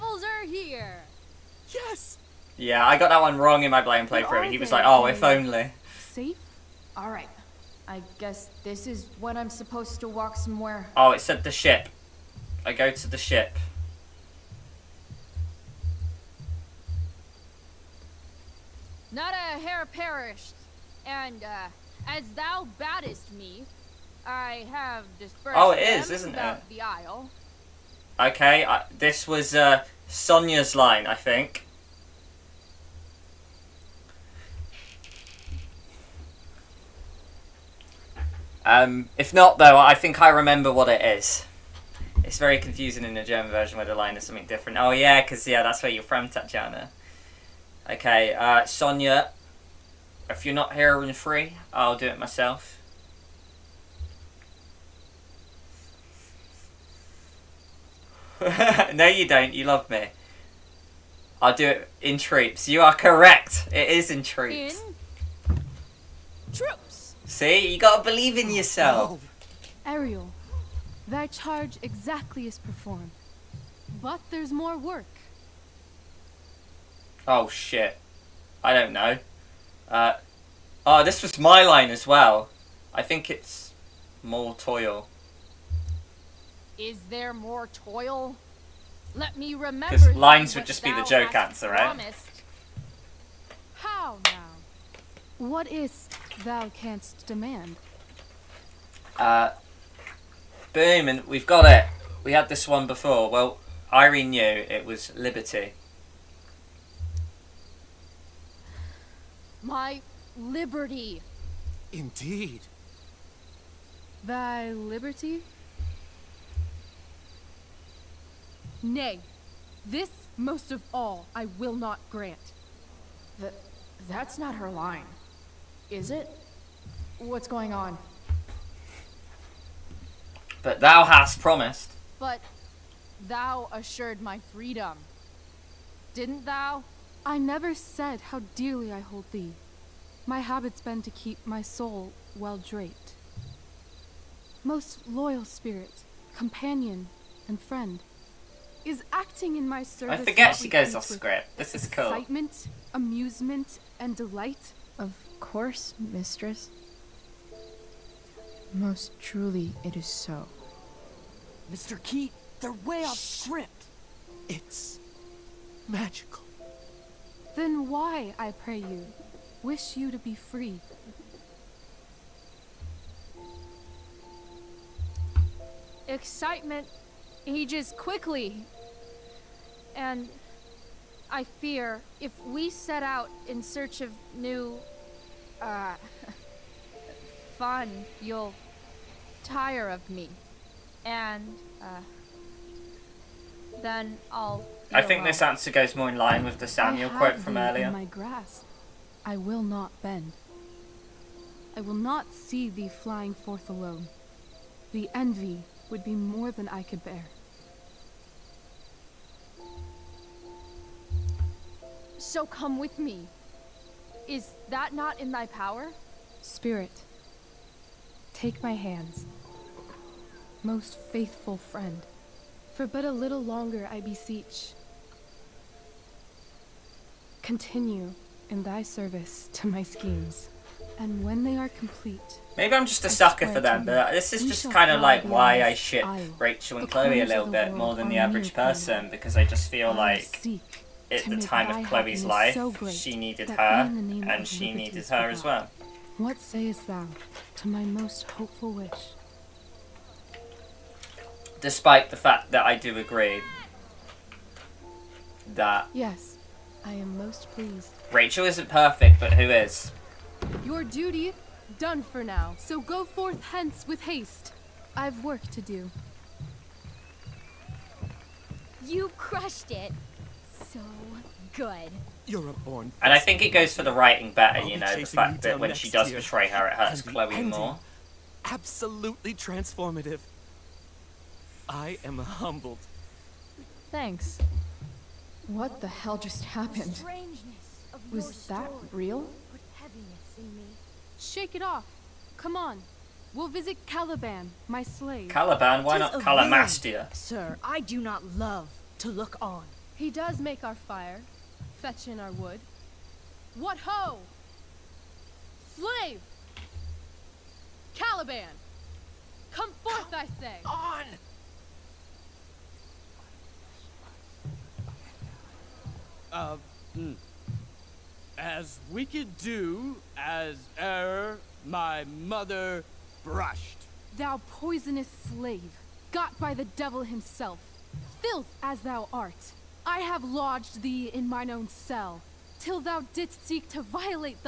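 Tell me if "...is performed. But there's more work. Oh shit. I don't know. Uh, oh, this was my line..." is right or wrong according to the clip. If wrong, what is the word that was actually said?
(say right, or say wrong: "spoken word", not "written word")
right.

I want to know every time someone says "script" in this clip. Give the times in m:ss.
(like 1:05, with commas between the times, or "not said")
2:31, 2:43.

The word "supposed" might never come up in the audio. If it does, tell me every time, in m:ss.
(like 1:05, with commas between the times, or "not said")
0:09.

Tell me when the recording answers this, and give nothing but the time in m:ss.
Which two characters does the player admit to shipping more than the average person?
3:56.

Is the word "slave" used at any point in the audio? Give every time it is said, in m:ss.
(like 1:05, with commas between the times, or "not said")
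4:54, 5:05, 5:25.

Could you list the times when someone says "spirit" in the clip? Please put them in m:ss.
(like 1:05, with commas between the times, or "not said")
2:25, 3:36.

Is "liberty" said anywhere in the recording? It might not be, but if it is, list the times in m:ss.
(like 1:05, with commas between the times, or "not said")
1:45, 1:50, 1:54.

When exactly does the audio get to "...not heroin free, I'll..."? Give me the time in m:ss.
0:50.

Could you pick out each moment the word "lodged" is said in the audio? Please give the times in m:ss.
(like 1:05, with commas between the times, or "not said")
5:30.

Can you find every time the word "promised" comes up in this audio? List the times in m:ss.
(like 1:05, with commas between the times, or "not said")
1:31, 2:11.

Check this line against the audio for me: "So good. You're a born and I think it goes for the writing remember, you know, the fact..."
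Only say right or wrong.
wrong.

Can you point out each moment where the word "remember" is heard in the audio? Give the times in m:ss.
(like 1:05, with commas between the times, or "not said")
0:40, 1:29.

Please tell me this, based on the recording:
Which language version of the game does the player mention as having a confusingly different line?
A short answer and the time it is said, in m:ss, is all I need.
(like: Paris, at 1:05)
German, at 0:43.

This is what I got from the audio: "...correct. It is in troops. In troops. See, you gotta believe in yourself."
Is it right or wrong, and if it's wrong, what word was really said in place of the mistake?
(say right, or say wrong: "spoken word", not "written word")
right.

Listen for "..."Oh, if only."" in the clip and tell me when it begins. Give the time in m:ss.
0:04.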